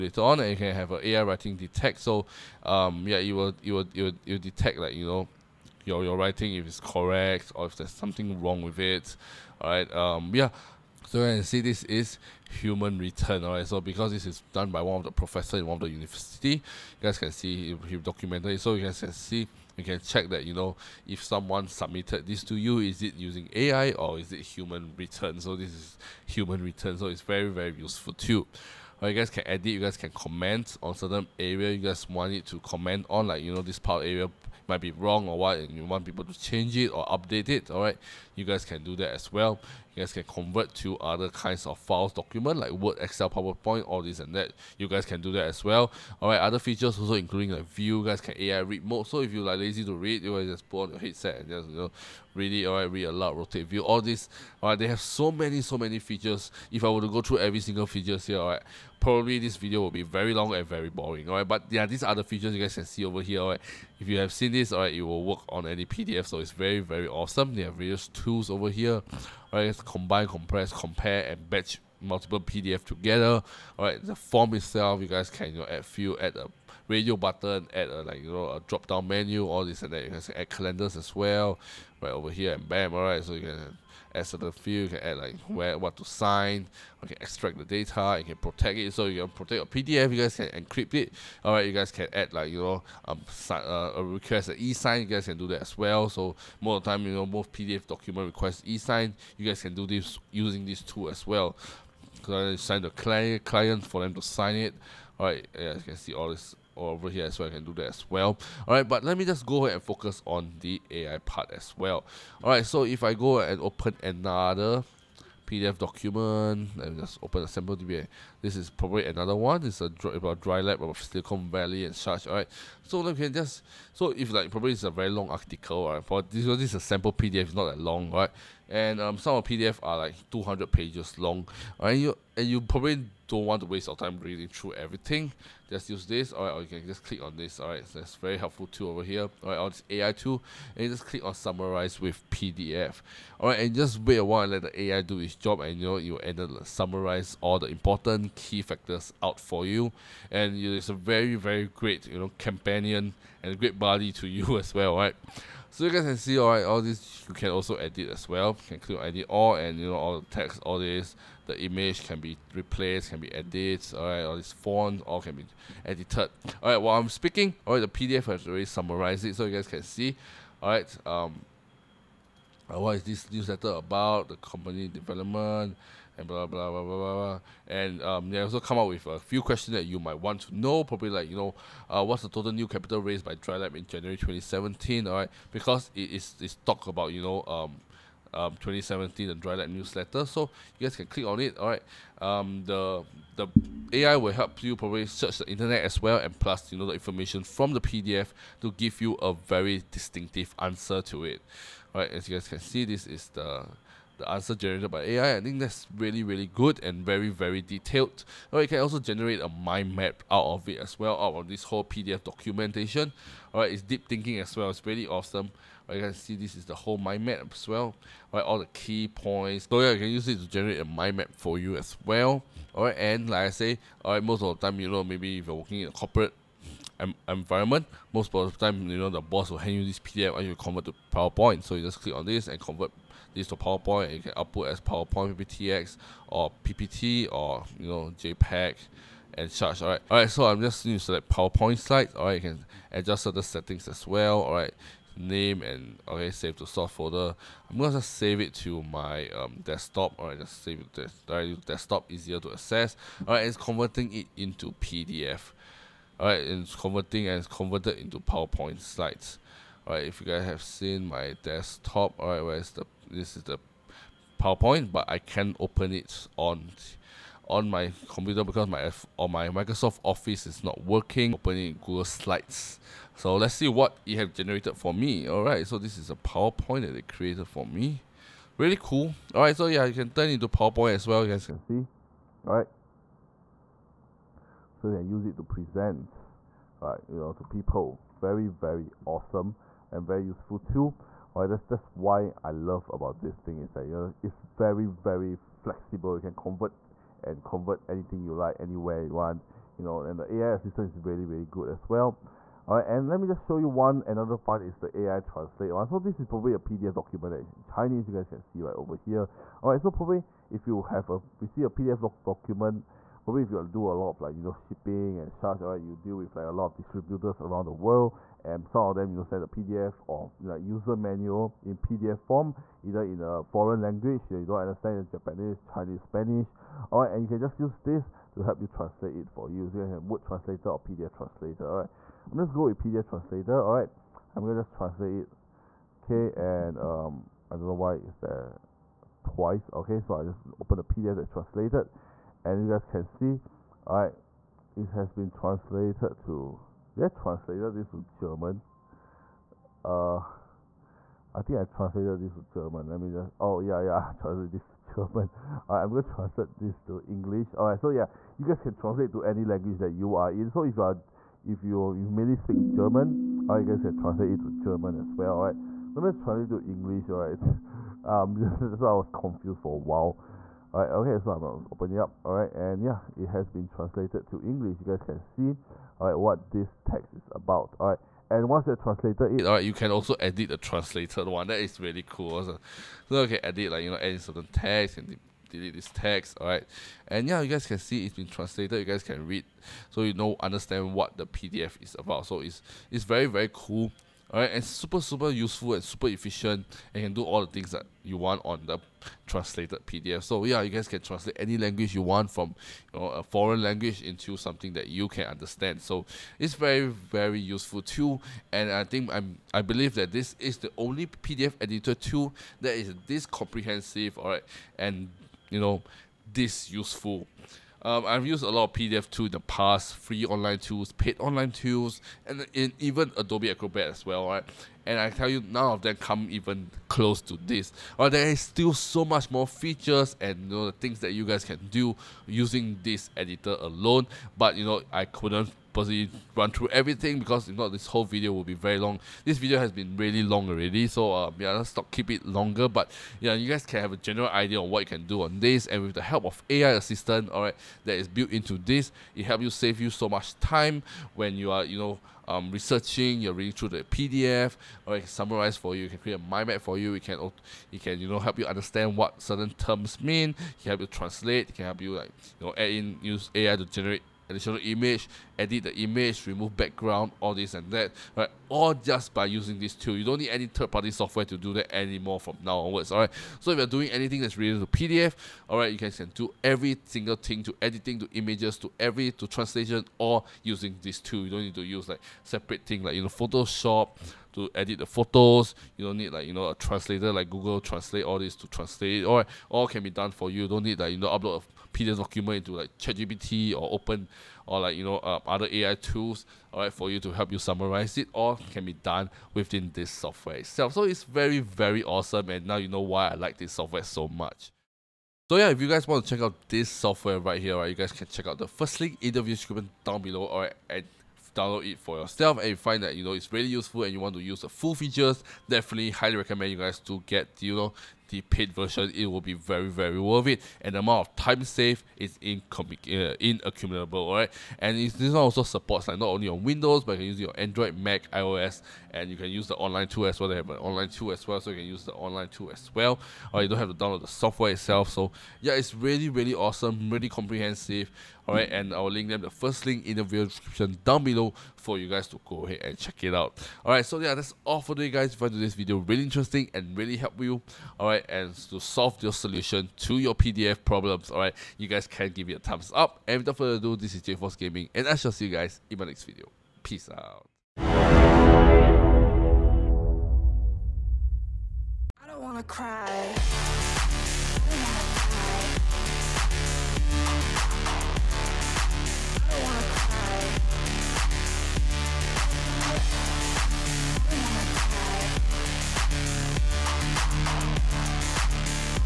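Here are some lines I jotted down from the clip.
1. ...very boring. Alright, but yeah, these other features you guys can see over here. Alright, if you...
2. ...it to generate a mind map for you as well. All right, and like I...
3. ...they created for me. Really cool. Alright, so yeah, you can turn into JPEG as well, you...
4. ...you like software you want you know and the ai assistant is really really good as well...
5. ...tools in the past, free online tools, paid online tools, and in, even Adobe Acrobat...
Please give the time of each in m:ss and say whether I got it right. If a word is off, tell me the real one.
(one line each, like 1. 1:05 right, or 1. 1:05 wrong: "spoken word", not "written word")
1. 1:00 right
2. 3:40 right
3. 4:36 wrong: "PowerPoint", not "JPEG"
4. 4:58 wrong: "anywhere", not "software"
5. 6:59 right.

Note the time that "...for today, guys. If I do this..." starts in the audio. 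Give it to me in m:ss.
9:04.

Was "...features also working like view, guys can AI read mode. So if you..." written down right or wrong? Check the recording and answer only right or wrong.
wrong.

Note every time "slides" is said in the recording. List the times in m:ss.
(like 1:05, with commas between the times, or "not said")
4:01, 4:18, 4:32.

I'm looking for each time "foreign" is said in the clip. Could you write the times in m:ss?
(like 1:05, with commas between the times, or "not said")
5:23, 6:43.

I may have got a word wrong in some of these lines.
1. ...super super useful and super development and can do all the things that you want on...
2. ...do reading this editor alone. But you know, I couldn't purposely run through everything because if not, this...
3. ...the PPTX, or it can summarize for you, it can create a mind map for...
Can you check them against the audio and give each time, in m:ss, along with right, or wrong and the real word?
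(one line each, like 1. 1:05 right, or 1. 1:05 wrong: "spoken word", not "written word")
1. 6:34 wrong: "efficient", not "development"
2. 7:11 wrong: "using", not "reading"
3. 7:33 wrong: "PDF", not "PPTX".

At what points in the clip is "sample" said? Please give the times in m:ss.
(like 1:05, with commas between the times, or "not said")
1:57, 2:06.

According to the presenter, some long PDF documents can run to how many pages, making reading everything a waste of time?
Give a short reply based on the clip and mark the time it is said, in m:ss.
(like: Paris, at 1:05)
200, at 2:10.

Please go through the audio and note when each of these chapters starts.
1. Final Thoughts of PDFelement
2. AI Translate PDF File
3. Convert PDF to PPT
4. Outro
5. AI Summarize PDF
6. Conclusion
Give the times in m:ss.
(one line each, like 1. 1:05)
1. 6:48
2. 5:03
3. 3:43
4. 9:17
5. 2:03
6. 8:24.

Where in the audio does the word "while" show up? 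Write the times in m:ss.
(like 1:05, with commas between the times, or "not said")
2:24, 2:46, 6:09.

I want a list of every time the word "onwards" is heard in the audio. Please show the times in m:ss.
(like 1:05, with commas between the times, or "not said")
7:52.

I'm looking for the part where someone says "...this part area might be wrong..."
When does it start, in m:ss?
0:33.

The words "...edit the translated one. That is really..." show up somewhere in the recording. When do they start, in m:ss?
6:20.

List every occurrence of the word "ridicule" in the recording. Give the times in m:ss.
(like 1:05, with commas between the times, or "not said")
not said.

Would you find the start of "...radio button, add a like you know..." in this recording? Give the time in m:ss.
1:16.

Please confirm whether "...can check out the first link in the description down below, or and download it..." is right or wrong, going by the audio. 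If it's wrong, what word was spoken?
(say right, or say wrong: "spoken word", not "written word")
right.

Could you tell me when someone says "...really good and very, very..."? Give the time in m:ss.
3:26.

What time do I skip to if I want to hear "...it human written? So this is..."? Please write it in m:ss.
0:24.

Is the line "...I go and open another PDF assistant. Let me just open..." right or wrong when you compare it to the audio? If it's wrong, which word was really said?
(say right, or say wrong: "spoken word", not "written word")
wrong: "document", not "assistant".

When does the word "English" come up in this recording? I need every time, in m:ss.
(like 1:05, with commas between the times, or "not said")
5:57, 6:06, 6:14.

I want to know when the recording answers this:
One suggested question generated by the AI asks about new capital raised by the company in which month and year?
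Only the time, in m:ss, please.
3:03.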